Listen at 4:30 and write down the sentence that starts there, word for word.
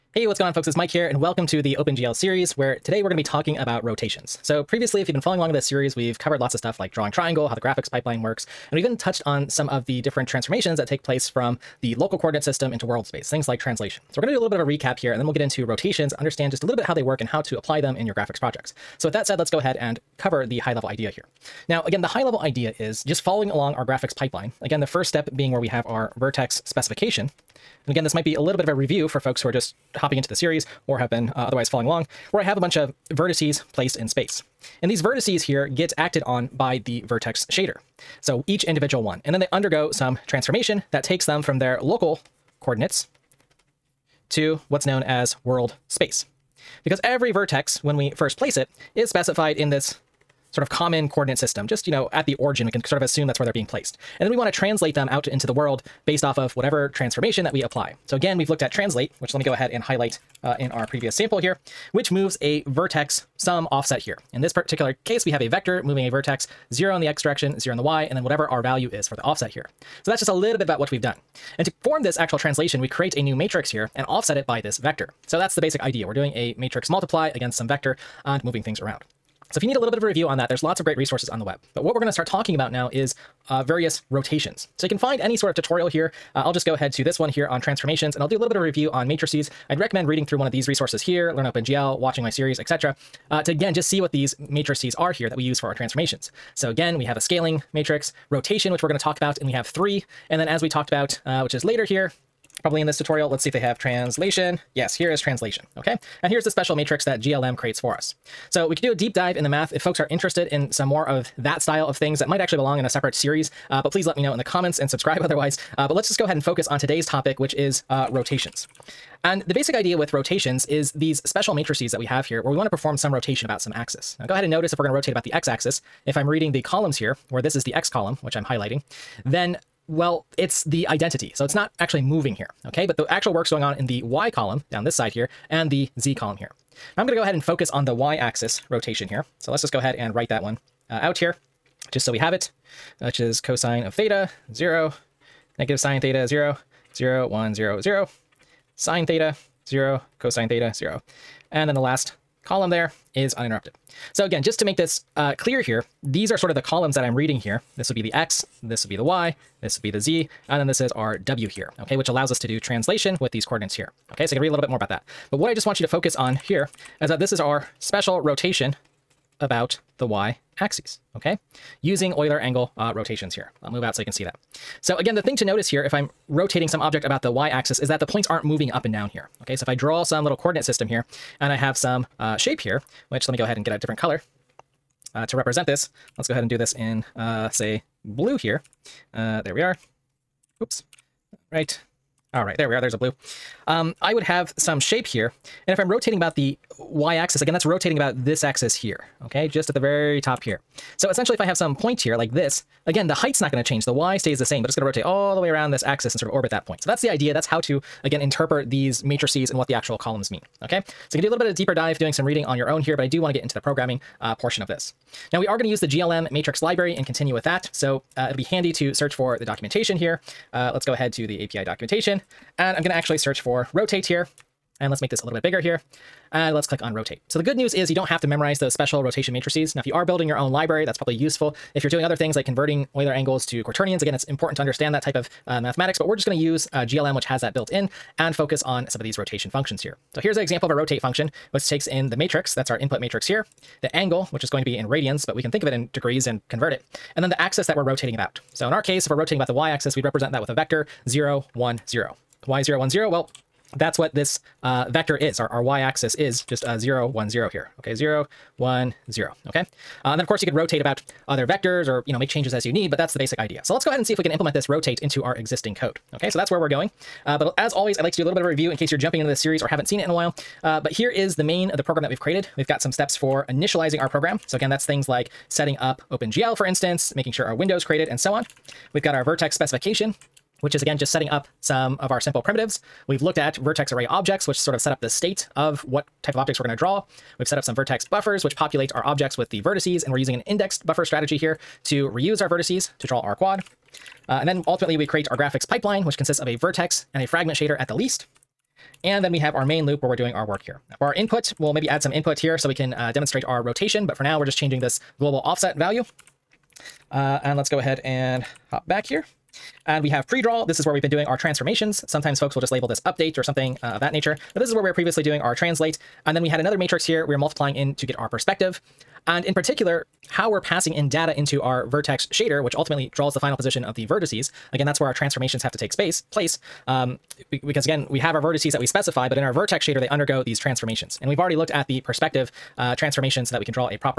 Uh, but here is the main of the program that we've created.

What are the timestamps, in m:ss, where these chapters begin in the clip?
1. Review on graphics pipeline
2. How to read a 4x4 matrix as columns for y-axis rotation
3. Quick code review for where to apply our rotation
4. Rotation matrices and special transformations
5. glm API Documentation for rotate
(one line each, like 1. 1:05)
1. 0:26
2. 2:34
3. 4:28
4. 1:25
5. 3:38.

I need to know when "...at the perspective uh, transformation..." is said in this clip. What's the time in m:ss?
5:31.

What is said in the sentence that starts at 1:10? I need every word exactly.
So that's just a little bit about what we've done.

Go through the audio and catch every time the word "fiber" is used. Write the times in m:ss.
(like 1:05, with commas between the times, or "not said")
not said.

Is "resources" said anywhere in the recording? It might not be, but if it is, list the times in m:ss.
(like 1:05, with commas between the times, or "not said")
1:20, 1:30.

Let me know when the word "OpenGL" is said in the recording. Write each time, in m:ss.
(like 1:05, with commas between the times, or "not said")
0:01, 1:31, 4:36.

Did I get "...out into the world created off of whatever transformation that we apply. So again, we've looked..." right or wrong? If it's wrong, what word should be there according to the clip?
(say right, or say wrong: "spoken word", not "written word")
wrong: "based", not "created".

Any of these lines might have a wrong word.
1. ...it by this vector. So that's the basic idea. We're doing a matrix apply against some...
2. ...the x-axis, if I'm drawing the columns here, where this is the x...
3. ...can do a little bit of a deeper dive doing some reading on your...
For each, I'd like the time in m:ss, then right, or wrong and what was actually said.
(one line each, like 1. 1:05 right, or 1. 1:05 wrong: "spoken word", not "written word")
1. 1:14 wrong: "multiply", not "apply"
2. 2:05 wrong: "reading", not "drawing"
3. 3:31 right.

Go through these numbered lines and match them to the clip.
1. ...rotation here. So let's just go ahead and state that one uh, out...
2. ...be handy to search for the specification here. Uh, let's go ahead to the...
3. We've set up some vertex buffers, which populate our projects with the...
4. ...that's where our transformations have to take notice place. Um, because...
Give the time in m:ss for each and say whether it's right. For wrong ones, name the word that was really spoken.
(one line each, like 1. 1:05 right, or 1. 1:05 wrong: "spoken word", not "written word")
1. 2:18 wrong: "write", not "state"
2. 3:38 wrong: "documentation", not "specification"
3. 4:47 wrong: "objects", not "projects"
4. 5:24 wrong: "space", not "notice".